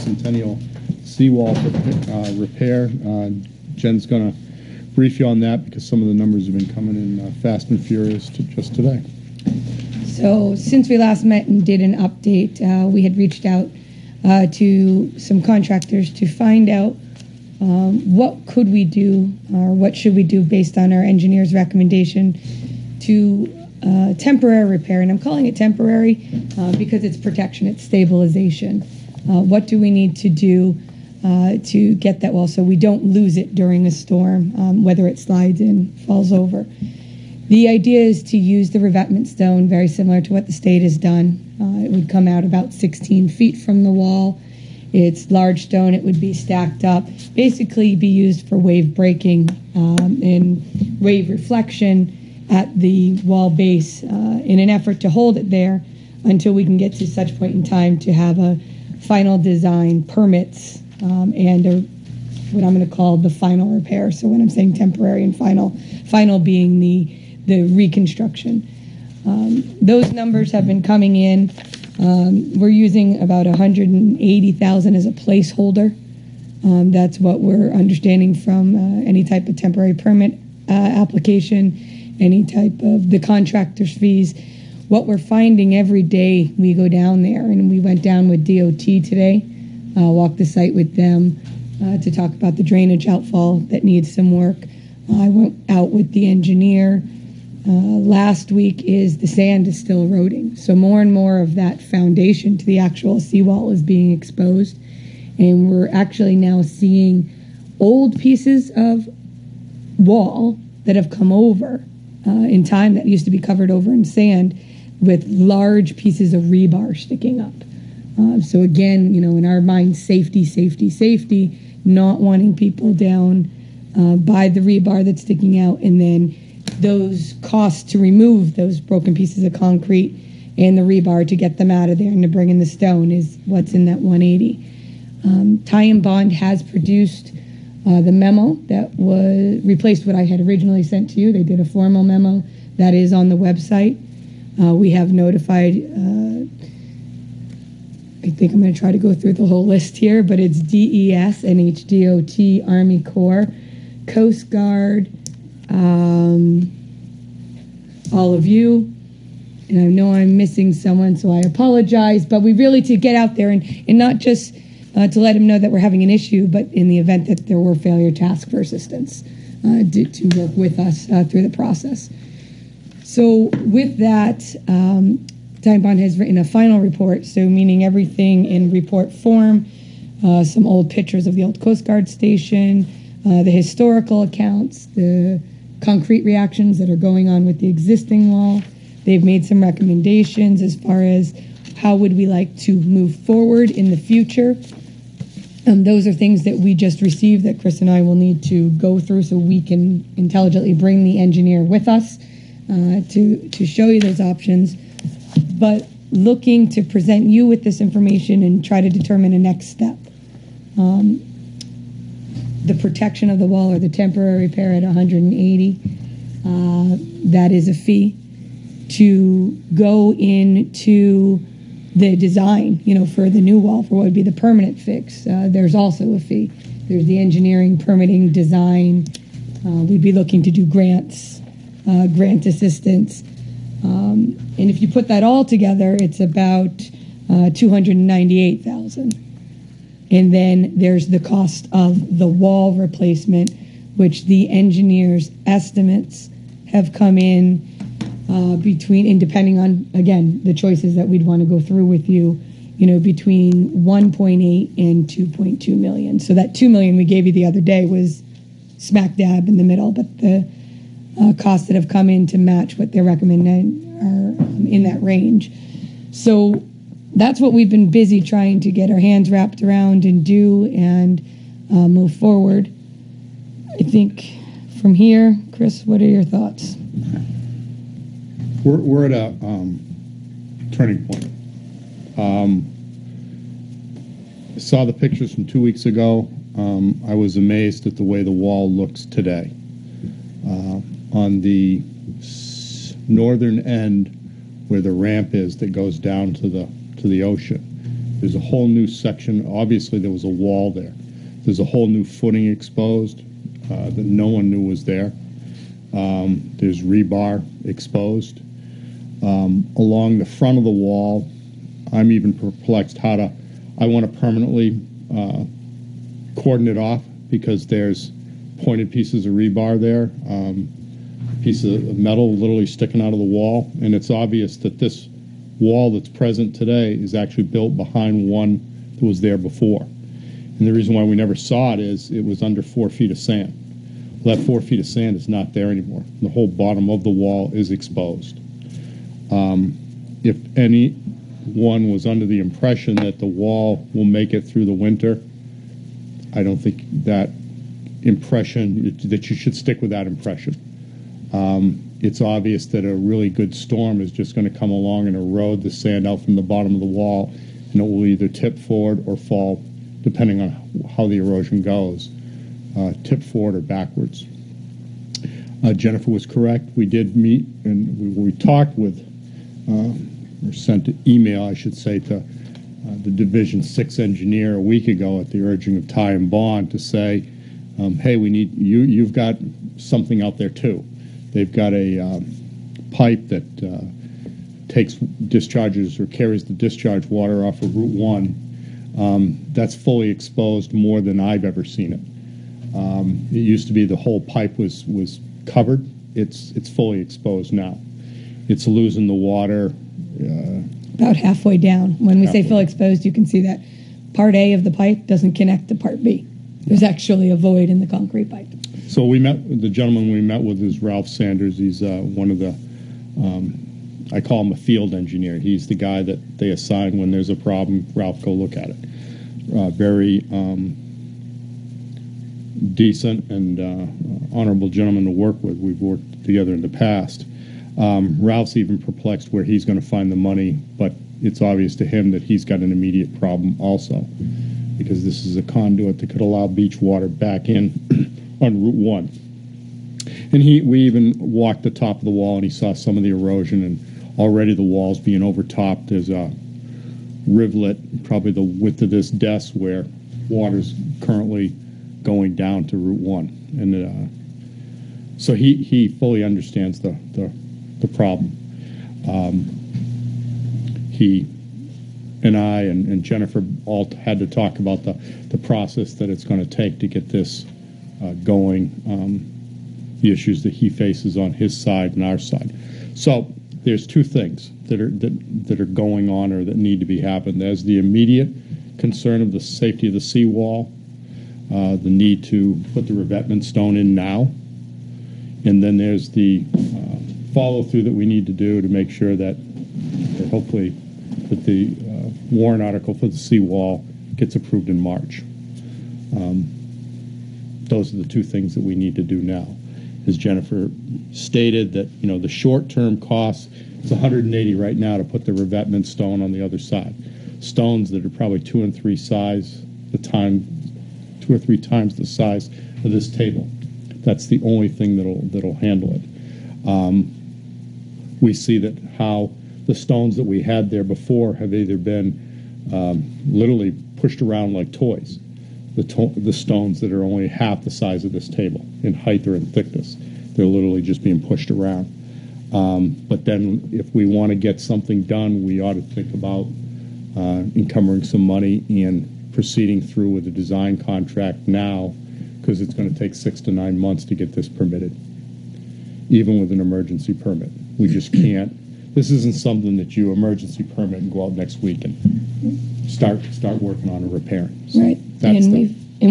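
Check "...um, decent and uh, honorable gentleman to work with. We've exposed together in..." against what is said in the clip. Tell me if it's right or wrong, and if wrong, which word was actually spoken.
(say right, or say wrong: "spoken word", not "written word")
wrong: "worked", not "exposed".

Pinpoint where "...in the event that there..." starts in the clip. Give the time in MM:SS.
02:46.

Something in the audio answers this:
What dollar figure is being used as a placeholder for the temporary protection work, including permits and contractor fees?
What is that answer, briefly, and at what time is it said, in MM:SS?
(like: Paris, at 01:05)
$180,000, at 01:13.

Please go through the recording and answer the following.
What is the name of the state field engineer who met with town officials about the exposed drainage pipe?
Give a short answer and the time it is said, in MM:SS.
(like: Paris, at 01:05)
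Ralph Sanders, at 06:50.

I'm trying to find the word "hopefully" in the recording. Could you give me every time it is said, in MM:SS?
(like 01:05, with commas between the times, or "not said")
08:10.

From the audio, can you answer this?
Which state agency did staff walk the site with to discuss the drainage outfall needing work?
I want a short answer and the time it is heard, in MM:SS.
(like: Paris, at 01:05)
DOT, at 01:28.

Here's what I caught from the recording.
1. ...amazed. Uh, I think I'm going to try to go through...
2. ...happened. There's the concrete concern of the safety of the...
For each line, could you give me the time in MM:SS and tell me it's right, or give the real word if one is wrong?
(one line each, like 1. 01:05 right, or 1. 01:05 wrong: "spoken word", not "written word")
1. 02:25 wrong: "notified", not "amazed"
2. 07:56 wrong: "immediate", not "concrete".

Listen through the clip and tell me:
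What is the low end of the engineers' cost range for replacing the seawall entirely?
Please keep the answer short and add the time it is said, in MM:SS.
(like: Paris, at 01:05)
1.8 million, at 04:13.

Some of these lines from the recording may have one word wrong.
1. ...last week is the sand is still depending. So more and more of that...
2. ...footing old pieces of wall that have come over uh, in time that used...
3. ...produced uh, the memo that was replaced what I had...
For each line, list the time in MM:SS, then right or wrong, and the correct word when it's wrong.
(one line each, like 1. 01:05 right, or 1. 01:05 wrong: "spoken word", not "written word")
1. 01:37 wrong: "eroding", not "depending"
2. 01:46 wrong: "seeing", not "footing"
3. 02:16 right.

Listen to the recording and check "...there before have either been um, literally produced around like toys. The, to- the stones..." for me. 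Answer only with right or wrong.
wrong.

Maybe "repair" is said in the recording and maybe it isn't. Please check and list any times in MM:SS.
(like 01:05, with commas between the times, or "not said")
00:02, 00:24, 01:03, 03:34, 09:14.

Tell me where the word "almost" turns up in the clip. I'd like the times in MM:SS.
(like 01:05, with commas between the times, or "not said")
not said.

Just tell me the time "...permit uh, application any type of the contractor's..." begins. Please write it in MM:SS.
01:19.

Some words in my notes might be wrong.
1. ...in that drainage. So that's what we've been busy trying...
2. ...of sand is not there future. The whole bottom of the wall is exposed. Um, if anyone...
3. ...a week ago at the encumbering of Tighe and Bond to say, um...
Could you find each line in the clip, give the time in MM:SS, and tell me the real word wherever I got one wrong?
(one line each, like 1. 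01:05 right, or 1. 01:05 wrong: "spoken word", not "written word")
1. 04:24 wrong: "range", not "drainage"
2. 05:34 wrong: "anymore", not "future"
3. 06:14 wrong: "urging", not "encumbering".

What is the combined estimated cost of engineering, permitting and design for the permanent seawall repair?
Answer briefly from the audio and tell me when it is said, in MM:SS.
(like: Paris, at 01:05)
$298,000, at 03:57.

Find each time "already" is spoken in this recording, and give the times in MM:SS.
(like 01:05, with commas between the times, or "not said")
07:24.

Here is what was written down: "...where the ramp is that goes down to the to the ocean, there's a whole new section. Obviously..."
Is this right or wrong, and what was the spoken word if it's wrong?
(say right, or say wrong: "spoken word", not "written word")
right.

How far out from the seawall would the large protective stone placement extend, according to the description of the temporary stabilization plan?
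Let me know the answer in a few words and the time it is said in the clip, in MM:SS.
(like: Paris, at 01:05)
16 feet, at 00:42.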